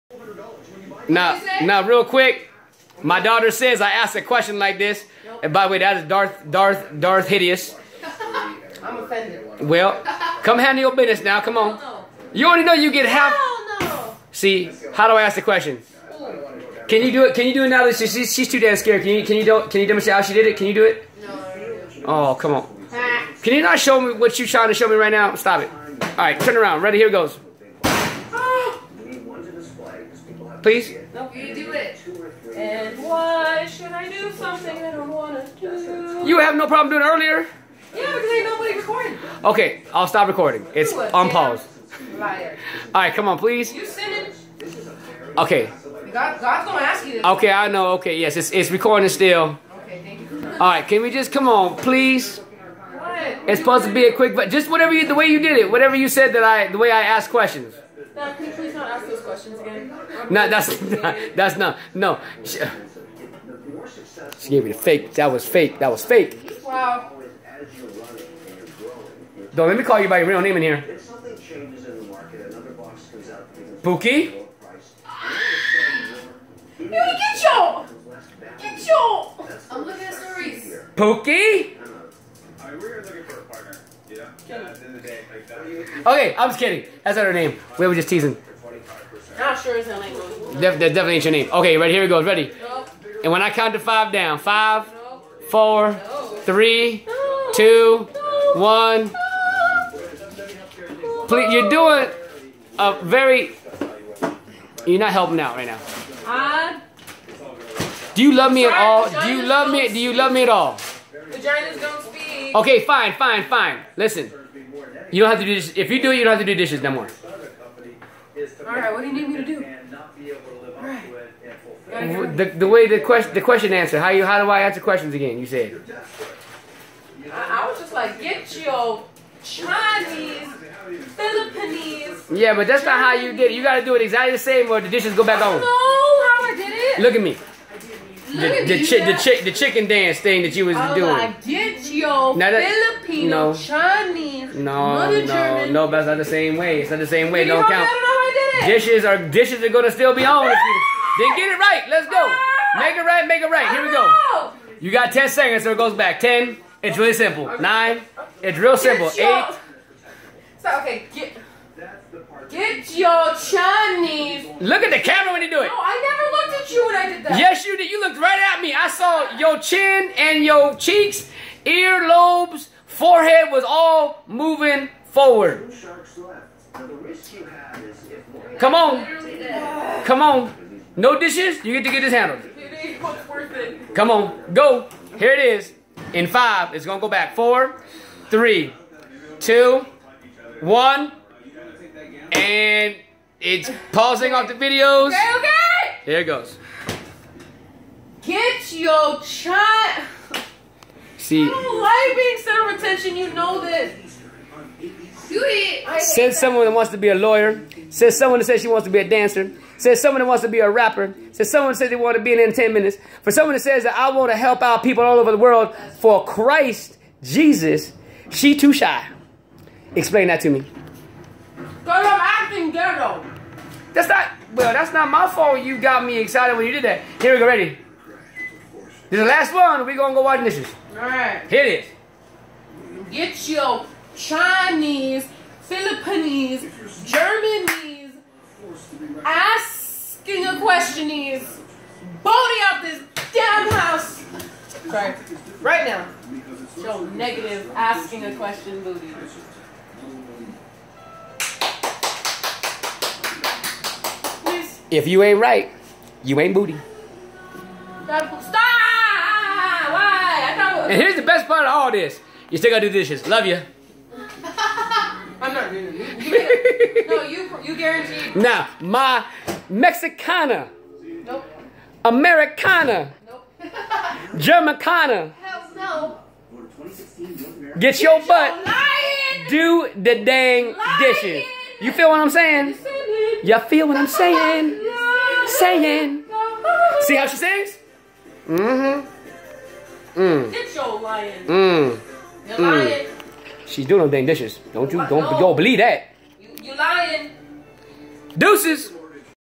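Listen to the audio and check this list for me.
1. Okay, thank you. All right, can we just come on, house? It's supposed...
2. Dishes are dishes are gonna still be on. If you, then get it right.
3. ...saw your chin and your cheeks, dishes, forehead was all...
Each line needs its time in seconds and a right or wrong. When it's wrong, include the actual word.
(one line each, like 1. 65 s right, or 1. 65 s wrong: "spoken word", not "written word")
1. 49 s wrong: "please", not "house"
2. 148 s right
3. 168 s wrong: "earlobes", not "dishes".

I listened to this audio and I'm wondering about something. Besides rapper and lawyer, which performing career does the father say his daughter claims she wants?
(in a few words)
Dancer.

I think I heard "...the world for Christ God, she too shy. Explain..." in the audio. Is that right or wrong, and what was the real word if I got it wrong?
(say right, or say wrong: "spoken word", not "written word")
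wrong: "Jesus", not "God".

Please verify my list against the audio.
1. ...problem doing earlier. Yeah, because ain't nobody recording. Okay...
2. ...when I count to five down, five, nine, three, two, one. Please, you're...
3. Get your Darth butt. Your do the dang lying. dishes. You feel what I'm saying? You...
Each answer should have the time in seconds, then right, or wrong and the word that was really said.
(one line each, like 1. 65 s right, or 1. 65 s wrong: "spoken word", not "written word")
1. 36 s right
2. 93 s wrong: "four", not "nine"
3. 277 s wrong: "Get", not "Darth".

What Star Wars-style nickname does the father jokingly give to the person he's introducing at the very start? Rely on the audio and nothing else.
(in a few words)
Darth Hideous.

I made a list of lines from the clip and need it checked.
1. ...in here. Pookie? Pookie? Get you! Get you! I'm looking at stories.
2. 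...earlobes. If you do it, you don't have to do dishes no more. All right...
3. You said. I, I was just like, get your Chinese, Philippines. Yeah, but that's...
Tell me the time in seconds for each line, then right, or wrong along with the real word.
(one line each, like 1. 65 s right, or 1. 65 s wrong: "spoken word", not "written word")
1. 70 s right
2. 115 s wrong: "dishes", not "earlobes"
3. 125 s right.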